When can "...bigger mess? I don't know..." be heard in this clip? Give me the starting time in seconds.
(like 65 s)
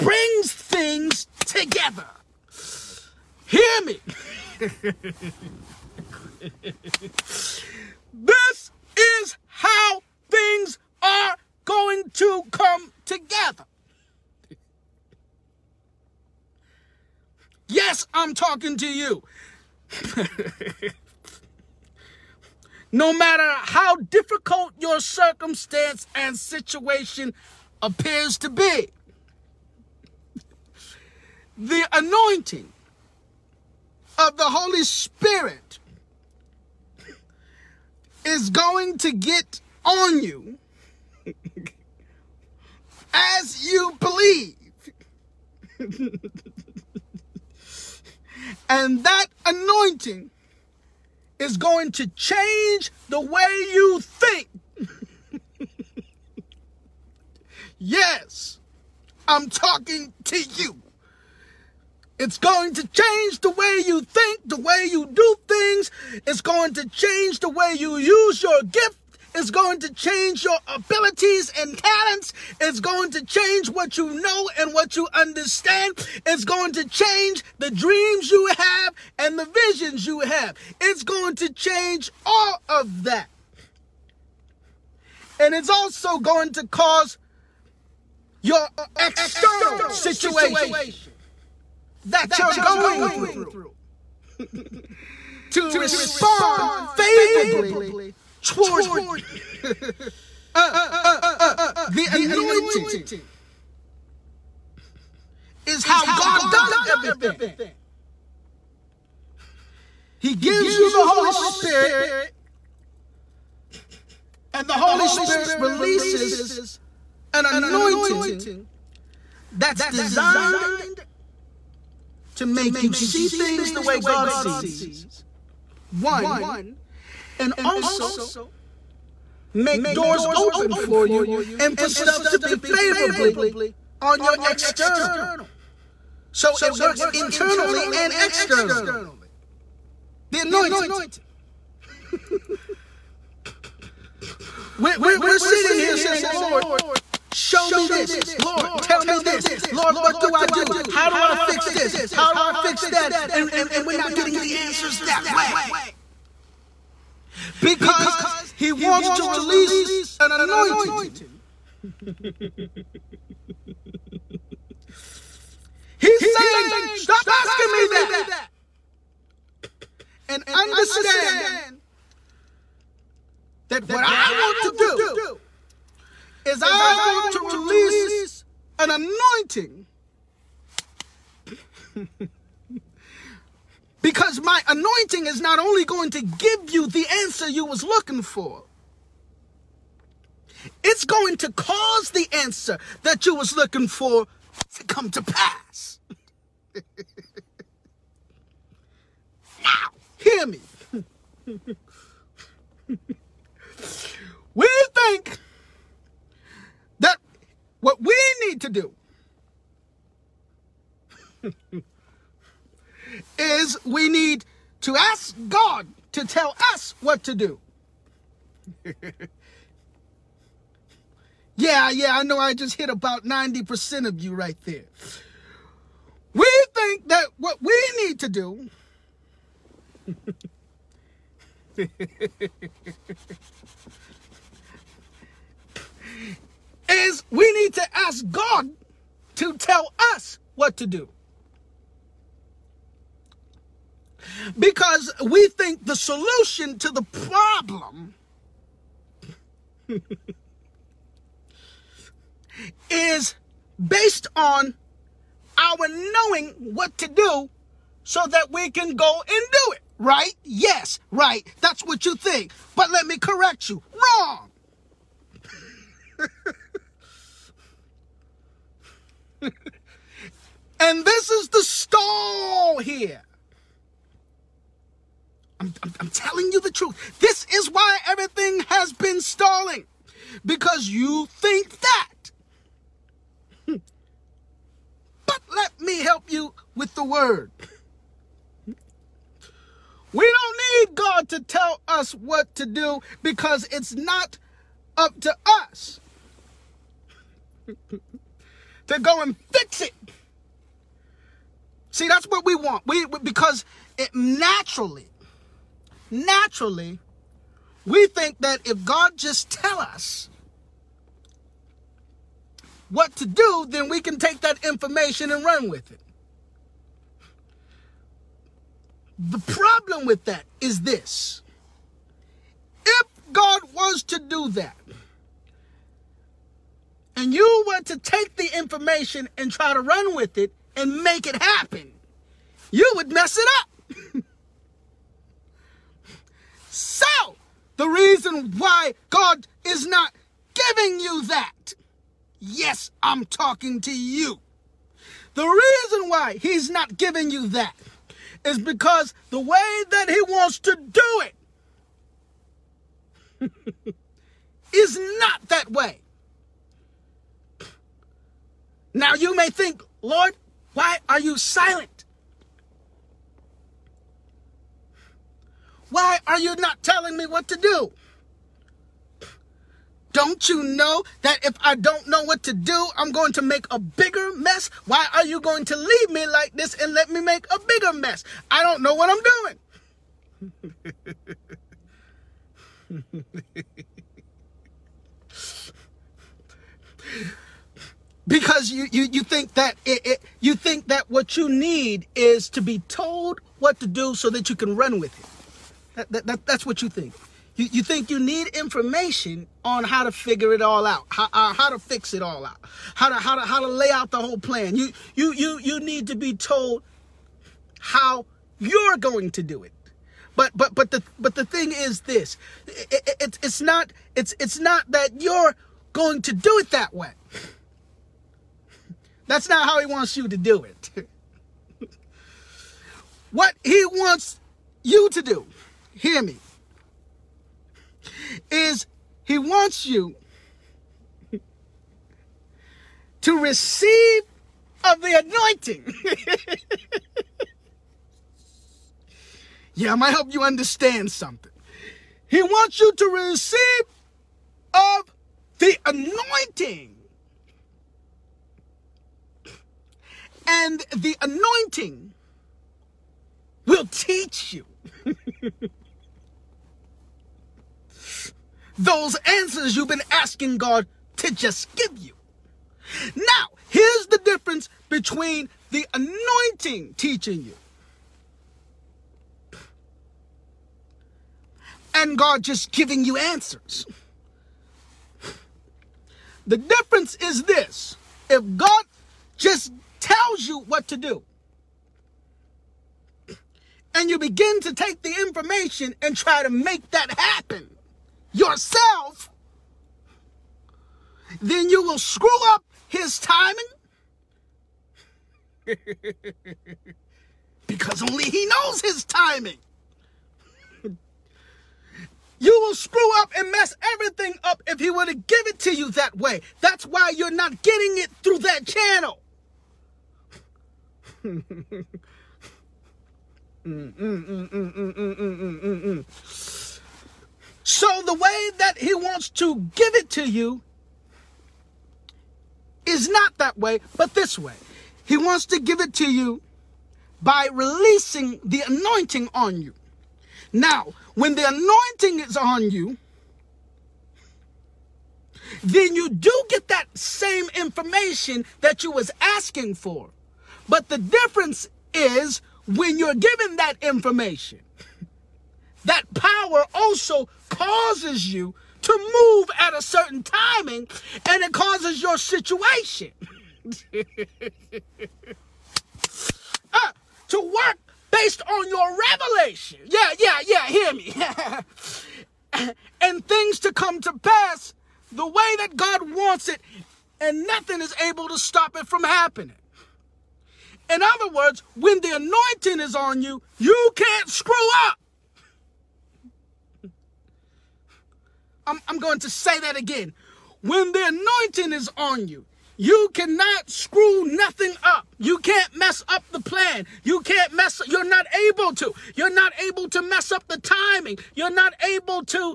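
377 s.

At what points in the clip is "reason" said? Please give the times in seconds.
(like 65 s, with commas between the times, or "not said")
337 s, 345 s.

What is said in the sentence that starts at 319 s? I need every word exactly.
The problem with that is this.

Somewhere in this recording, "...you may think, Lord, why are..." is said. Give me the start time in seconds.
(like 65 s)
359 s.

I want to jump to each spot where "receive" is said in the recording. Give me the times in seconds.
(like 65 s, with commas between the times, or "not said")
433 s, 443 s.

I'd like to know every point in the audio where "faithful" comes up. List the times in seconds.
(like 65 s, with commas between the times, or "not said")
not said.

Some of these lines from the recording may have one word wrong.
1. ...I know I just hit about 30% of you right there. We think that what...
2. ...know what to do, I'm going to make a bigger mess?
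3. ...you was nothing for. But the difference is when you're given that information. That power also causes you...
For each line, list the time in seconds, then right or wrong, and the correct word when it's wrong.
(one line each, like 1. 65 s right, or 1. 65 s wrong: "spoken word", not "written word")
1. 222 s wrong: "90", not "30"
2. 372 s right
3. 538 s wrong: "asking", not "nothing".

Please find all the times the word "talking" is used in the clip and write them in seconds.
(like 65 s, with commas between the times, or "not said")
18 s, 59 s, 343 s.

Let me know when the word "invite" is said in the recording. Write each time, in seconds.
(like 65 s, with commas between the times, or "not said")
not said.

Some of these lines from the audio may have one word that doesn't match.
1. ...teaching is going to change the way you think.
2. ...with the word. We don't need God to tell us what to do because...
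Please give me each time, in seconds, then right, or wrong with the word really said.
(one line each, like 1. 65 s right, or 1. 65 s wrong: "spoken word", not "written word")
1. 49 s wrong: "anointing", not "teaching"
2. 286 s right.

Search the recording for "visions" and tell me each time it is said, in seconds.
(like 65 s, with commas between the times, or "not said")
79 s.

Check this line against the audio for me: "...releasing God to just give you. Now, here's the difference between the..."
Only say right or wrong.
wrong.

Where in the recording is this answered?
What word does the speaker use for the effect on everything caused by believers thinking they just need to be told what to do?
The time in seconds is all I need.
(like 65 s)
279 s.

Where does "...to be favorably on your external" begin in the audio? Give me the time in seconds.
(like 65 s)
132 s.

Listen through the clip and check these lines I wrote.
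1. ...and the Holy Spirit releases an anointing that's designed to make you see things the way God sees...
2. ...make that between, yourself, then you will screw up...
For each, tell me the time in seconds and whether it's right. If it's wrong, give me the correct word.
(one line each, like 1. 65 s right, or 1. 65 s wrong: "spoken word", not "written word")
1. 114 s right
2. 486 s wrong: "happen", not "between".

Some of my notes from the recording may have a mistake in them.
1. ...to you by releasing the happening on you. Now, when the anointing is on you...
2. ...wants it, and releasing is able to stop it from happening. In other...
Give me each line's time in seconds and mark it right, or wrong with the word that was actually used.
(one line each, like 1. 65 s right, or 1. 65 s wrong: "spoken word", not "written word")
1. 525 s wrong: "anointing", not "happening"
2. 566 s wrong: "nothing", not "releasing".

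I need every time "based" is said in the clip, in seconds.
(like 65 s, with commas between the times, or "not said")
253 s, 558 s.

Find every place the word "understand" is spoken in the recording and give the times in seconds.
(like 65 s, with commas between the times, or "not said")
75 s, 170 s, 440 s.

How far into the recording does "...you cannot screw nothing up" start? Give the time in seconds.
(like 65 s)
582 s.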